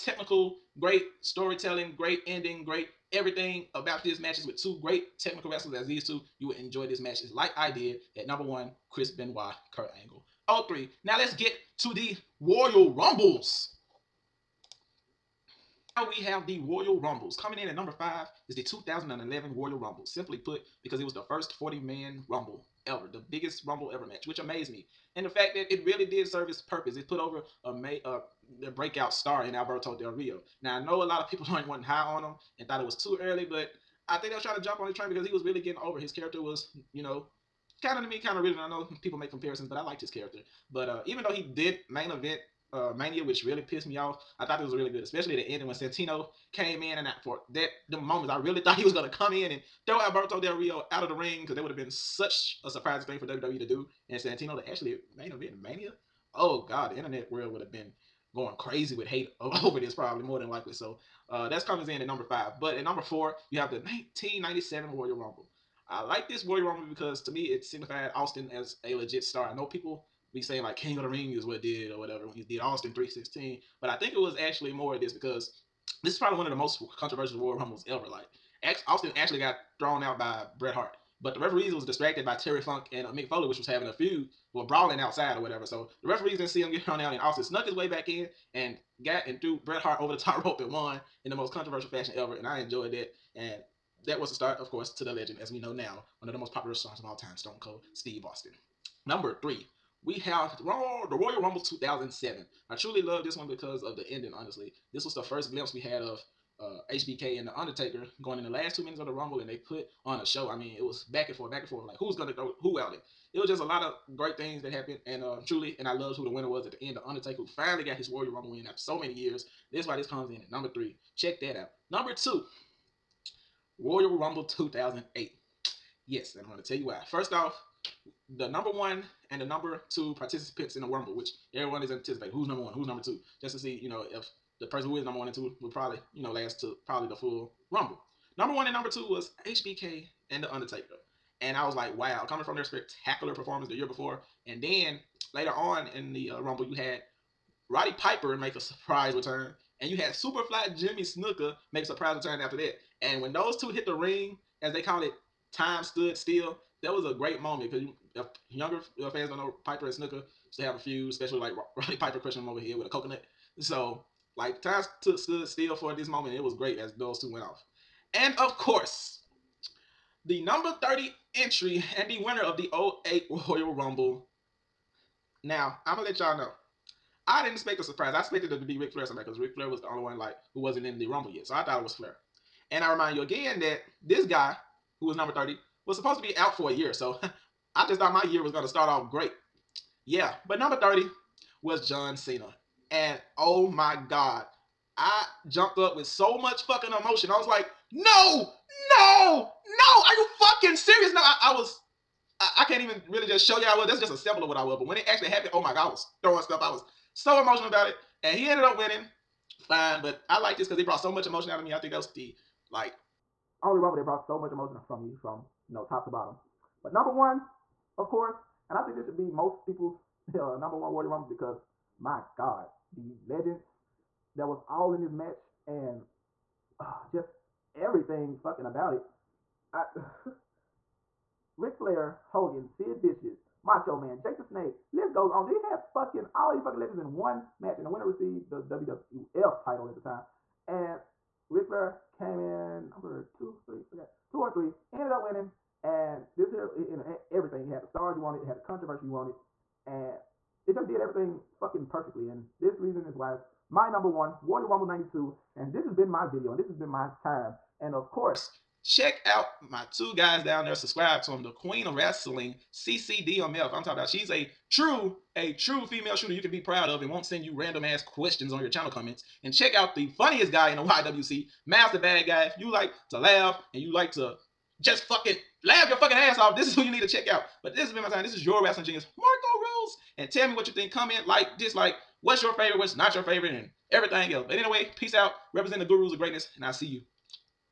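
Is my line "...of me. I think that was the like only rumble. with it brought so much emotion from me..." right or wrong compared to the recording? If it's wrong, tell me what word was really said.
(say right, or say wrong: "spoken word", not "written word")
right.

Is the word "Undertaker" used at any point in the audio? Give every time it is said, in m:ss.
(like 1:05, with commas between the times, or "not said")
1:47, 1:57, 2:20.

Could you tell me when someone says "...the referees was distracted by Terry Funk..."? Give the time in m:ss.
1:21.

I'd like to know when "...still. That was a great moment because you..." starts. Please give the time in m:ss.
2:36.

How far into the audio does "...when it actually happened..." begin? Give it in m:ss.
3:24.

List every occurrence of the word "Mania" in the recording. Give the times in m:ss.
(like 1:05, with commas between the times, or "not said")
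0:42, 0:55.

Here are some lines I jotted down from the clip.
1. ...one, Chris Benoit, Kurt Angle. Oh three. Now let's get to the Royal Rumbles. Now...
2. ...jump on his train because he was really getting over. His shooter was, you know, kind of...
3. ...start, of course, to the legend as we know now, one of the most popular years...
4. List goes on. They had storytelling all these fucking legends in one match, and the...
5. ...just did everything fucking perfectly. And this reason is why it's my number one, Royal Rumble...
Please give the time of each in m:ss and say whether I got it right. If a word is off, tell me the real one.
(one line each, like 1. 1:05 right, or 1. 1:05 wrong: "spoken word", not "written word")
1. 0:08 right
2. 0:34 wrong: "character", not "shooter"
3. 1:34 wrong: "stars", not "years"
4. 3:54 wrong: "fucking", not "storytelling"
5. 4:10 right.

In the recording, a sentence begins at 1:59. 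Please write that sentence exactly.
This is why this comes in at number three Check that out.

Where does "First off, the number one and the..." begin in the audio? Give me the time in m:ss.
2:07.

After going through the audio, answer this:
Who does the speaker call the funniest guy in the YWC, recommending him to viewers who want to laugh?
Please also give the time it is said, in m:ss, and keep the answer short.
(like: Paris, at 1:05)
Master Bad Guy, at 4:31.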